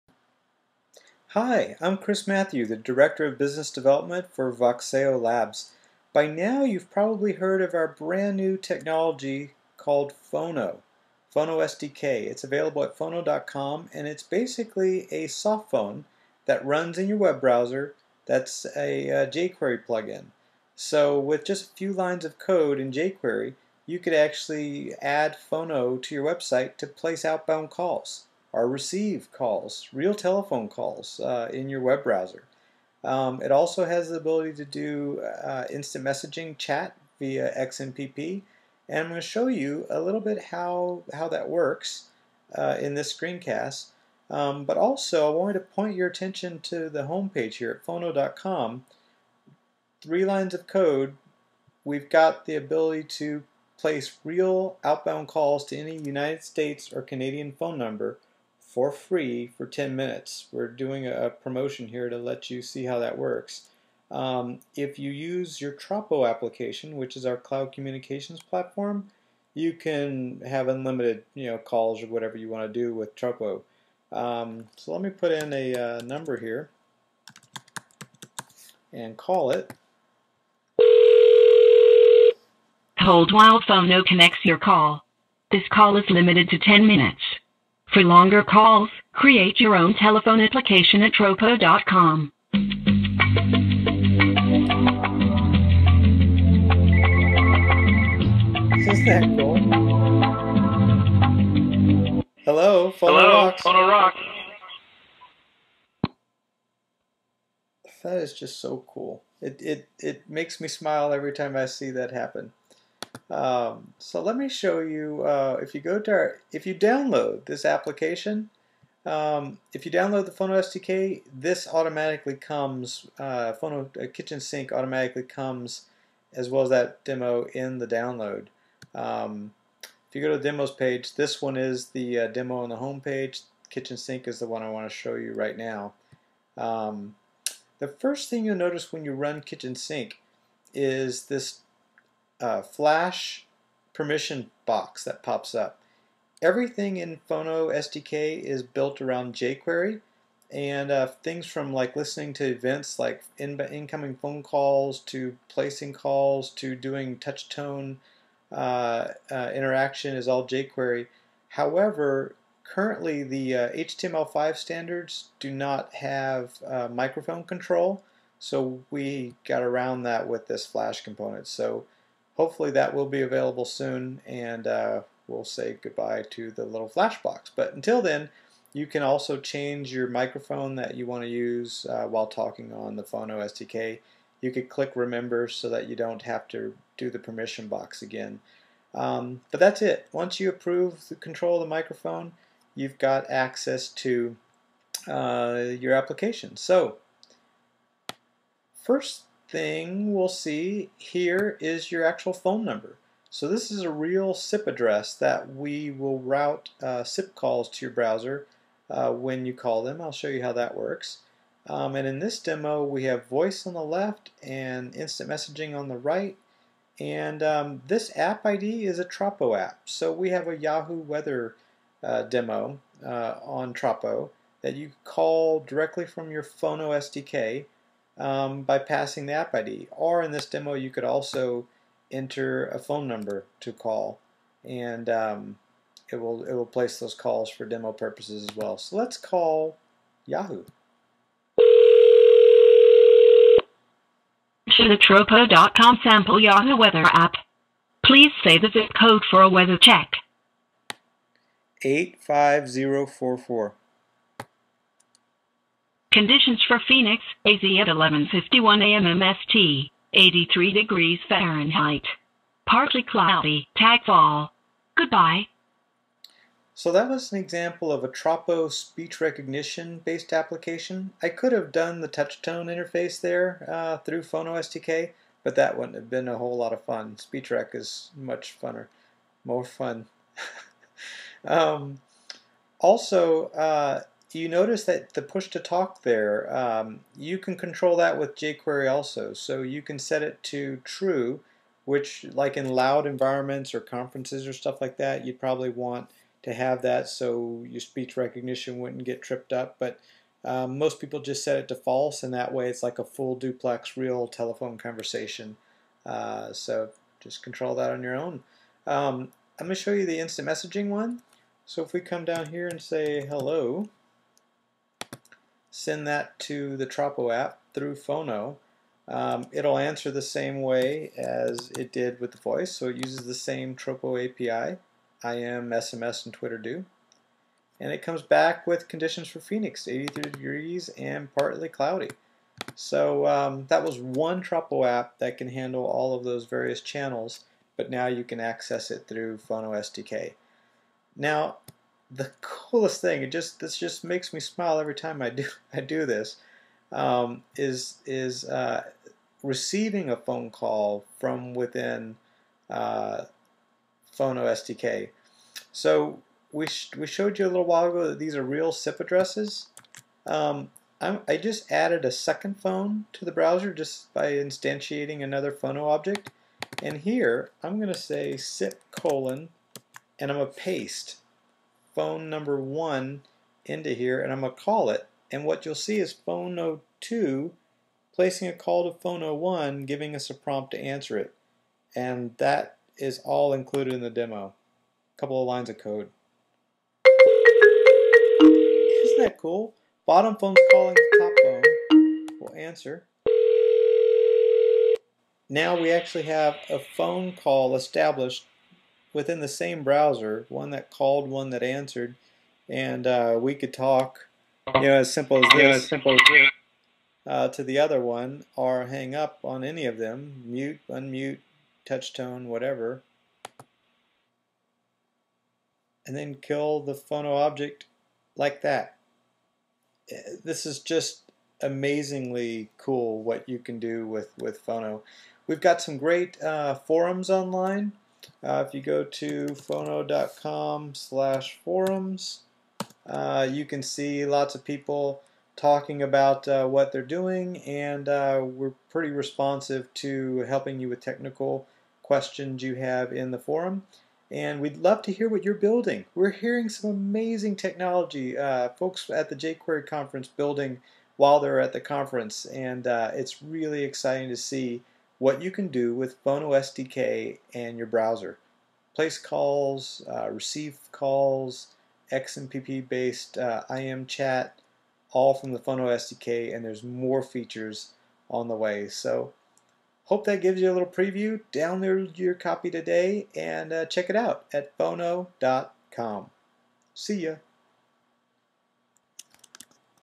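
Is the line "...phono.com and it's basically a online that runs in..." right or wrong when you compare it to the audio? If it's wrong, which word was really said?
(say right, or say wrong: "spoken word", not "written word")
wrong: "softphone", not "online".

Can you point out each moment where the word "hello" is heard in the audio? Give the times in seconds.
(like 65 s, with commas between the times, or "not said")
102 s, 313 s.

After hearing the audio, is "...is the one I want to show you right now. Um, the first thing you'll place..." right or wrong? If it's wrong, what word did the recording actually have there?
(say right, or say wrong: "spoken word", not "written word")
wrong: "notice", not "place".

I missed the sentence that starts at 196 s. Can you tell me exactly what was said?
So first thing we'll see here is your actual phone number.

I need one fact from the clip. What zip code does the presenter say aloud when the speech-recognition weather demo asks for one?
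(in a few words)
85044.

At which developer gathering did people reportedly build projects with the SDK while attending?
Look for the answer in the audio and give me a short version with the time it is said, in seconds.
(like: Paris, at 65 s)
jQuery conference, at 449 s.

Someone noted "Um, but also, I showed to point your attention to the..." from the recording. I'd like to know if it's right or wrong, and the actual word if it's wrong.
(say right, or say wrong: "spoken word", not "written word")
wrong: "wanted", not "showed".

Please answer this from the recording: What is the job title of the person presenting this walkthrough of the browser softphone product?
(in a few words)
Director of Business Development.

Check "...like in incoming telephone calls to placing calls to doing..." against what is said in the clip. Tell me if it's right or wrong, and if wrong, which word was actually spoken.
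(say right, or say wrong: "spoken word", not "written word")
wrong: "phone", not "telephone".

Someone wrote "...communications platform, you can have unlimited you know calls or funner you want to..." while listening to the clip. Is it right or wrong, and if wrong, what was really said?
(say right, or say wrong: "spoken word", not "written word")
wrong: "whatever", not "funner".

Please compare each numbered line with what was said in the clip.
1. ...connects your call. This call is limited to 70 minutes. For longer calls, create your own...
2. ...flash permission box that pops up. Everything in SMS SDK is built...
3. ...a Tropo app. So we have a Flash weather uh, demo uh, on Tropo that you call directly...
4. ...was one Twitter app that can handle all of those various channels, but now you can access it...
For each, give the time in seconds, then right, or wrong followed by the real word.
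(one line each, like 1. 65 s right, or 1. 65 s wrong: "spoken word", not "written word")
1. 84 s wrong: "10", not "70"
2. 142 s wrong: "Phono", not "SMS"
3. 218 s wrong: "Yahoo", not "Flash"
4. 333 s wrong: "Tropo", not "Twitter".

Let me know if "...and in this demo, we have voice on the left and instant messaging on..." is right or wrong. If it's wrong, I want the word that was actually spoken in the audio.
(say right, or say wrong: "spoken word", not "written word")
right.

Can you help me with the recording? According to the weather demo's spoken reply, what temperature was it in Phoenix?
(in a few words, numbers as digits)
83 degrees Fahrenheit.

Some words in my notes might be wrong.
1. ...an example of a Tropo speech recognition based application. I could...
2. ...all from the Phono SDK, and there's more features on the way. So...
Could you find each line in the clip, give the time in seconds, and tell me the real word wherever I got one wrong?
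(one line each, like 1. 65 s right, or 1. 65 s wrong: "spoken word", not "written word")
1. 267 s right
2. 465 s right.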